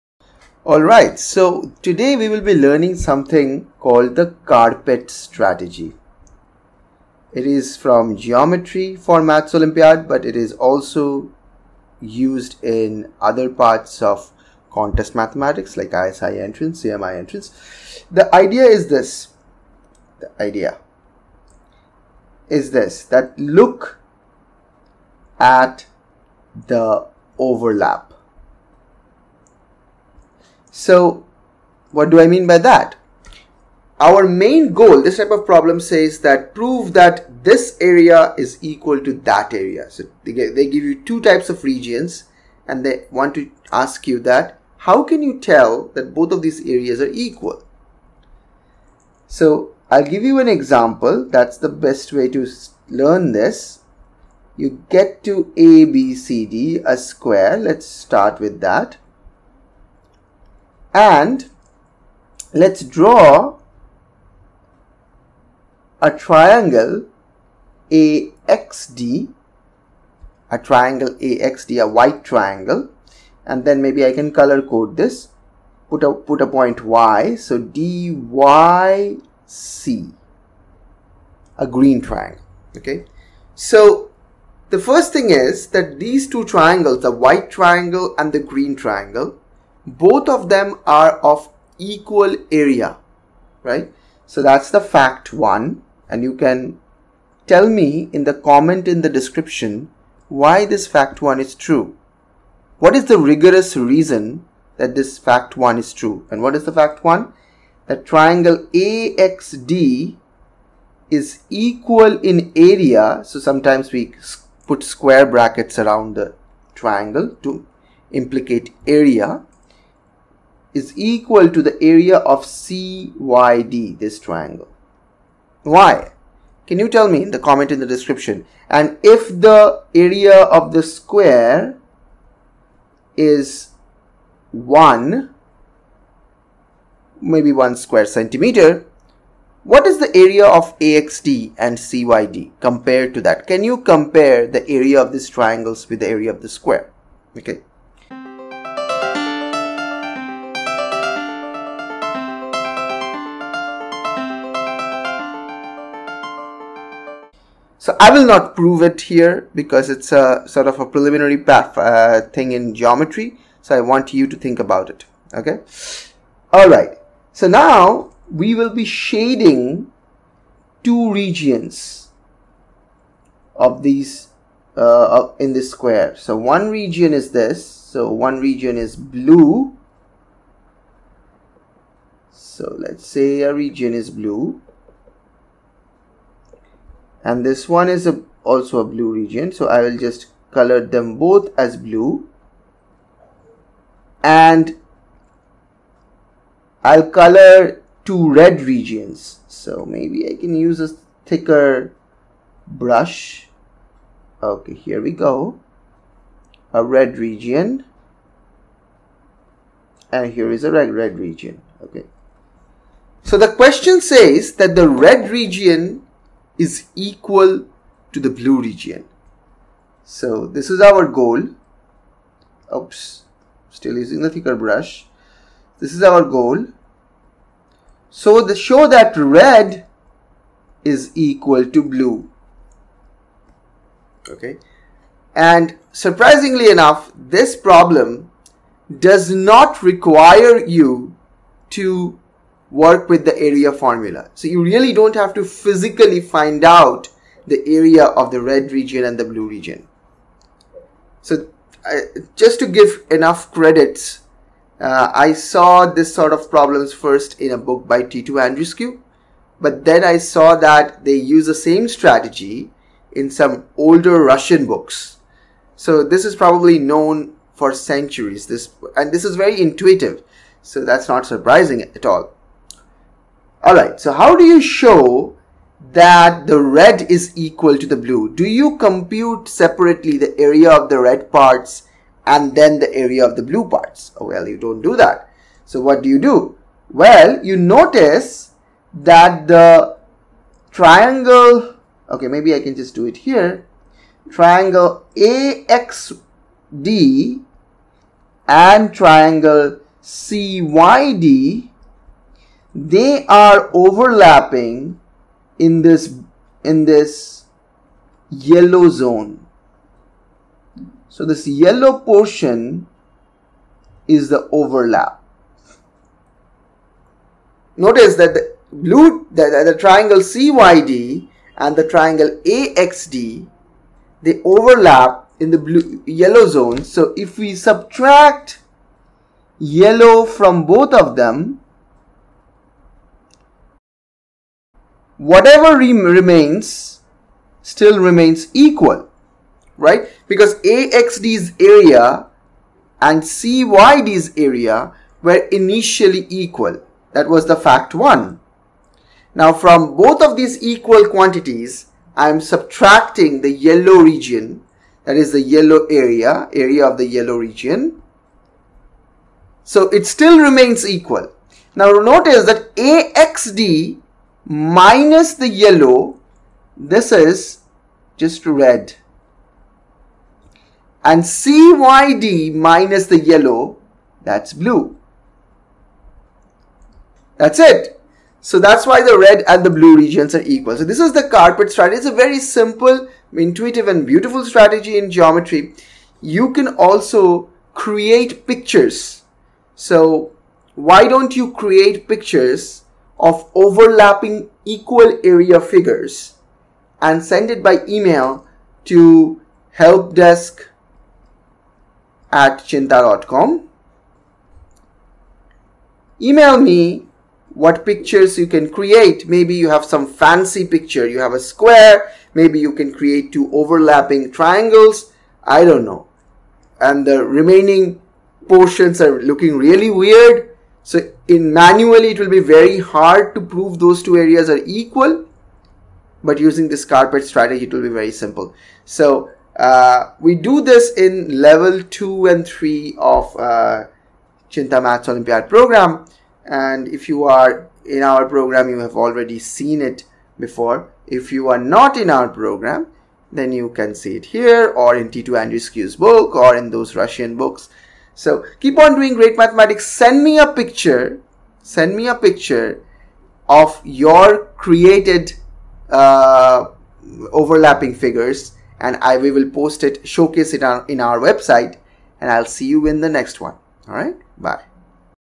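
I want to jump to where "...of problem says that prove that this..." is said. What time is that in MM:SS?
00:35.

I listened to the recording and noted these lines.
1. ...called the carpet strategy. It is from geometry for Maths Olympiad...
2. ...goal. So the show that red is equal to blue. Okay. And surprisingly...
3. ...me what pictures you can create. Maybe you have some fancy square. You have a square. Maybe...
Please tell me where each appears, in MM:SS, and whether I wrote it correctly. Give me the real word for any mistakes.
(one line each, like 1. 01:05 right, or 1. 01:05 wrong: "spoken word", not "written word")
1. 00:03 right
2. 03:46 right
3. 06:46 wrong: "picture", not "square".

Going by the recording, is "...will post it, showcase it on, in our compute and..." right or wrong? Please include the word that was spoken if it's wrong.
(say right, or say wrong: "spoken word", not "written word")
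wrong: "website", not "compute".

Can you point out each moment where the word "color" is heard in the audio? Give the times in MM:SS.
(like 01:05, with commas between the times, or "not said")
01:14, 03:10, 03:17.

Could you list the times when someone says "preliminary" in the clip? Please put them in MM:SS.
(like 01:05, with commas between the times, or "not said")
02:40.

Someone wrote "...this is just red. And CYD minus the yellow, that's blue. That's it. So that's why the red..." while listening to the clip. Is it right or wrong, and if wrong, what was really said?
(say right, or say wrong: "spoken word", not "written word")
right.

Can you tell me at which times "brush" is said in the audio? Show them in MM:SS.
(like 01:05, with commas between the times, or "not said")
03:22, 03:44.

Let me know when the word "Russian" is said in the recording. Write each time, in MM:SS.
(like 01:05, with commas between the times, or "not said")
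04:24, 07:26.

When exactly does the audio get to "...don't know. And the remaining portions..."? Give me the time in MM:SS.
06:55.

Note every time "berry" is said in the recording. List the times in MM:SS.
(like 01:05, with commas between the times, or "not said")
not said.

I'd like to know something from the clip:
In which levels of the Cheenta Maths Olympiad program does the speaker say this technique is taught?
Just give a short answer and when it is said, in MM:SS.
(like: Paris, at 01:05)
Levels 2 and 3, at 07:11.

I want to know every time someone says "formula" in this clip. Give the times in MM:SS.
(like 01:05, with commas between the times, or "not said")
04:03.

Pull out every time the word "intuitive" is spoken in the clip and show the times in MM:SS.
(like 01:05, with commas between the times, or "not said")
04:29, 06:23.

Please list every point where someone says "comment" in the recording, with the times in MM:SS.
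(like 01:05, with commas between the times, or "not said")
01:38, 02:07.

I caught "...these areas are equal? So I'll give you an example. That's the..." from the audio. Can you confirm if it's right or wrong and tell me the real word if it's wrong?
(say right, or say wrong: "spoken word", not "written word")
right.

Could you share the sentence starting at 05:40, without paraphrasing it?
Because AXD's area and CYD's area were initially equal.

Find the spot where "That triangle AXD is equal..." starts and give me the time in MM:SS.
01:47.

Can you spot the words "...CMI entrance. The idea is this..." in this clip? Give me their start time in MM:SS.
00:16.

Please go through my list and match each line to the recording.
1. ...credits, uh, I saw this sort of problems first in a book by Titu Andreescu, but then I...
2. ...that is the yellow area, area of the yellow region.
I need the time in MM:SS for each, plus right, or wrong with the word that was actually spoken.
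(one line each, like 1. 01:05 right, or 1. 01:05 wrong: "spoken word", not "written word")
1. 04:13 right
2. 05:55 right.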